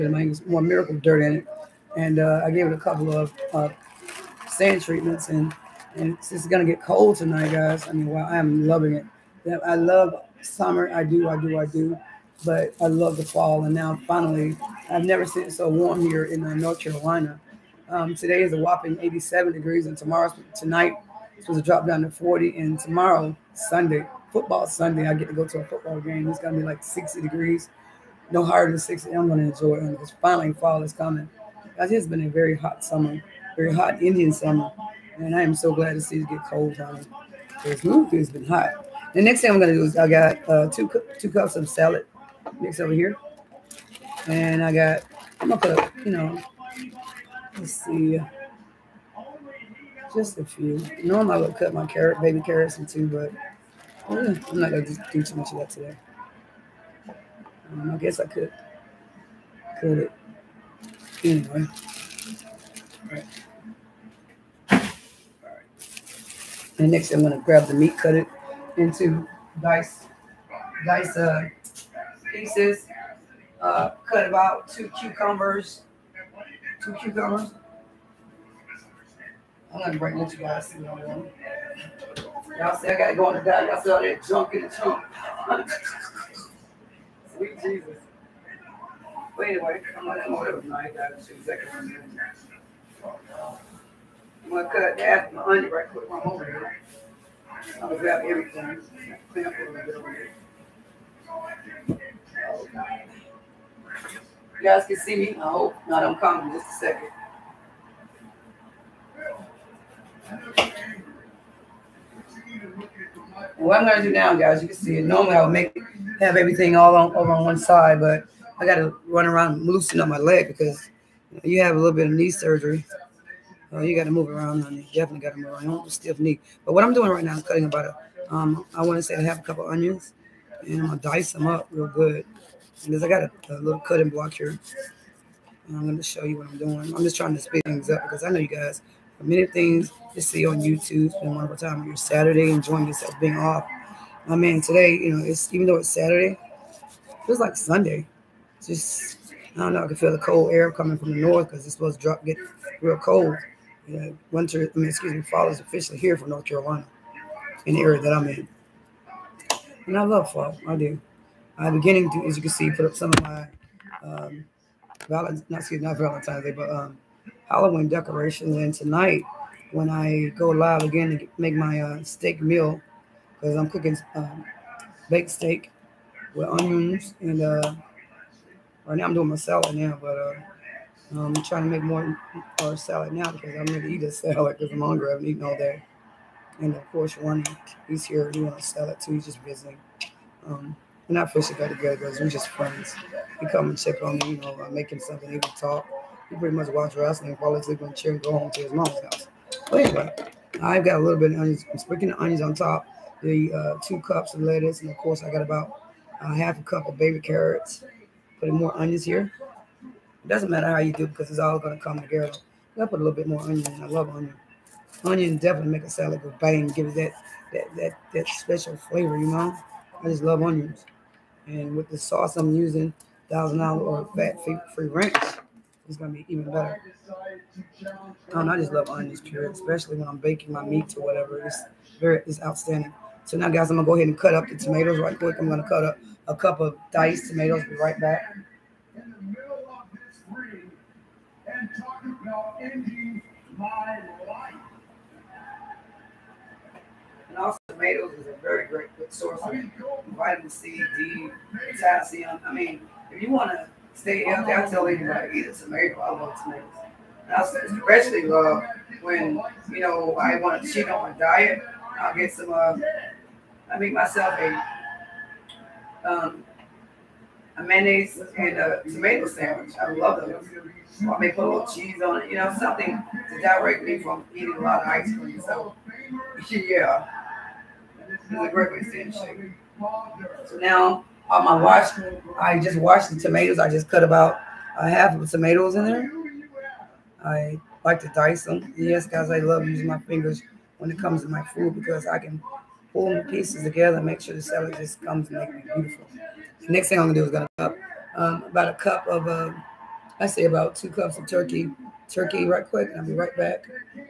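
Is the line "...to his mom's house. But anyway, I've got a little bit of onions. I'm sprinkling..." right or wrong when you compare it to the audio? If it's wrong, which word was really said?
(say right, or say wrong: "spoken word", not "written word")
right.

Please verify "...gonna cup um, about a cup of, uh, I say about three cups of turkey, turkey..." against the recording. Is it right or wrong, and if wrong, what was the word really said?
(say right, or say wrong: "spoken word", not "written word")
wrong: "two", not "three".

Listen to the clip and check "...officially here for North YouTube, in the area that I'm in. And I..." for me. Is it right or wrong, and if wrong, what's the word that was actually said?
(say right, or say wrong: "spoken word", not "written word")
wrong: "Carolina", not "YouTube".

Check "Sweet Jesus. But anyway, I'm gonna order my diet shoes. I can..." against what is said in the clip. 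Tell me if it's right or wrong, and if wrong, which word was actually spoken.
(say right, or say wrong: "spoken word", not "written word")
right.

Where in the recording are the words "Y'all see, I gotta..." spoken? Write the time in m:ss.
1:22.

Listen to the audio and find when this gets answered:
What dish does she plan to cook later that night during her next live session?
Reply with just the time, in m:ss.
2:55.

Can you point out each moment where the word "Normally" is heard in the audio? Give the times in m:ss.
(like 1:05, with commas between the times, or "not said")
0:51, 1:55.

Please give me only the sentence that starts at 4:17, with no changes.
And I especially love when, you know, I want to cheat on my diet.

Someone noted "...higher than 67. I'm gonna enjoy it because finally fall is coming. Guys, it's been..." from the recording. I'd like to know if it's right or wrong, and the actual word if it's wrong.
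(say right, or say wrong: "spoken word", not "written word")
wrong: "60", not "67".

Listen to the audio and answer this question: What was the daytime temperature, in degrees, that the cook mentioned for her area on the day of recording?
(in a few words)
87.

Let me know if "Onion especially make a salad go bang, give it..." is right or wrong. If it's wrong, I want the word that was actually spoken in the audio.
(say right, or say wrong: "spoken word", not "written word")
wrong: "definitely", not "especially".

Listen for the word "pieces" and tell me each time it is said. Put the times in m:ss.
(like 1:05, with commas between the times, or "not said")
1:12, 4:53.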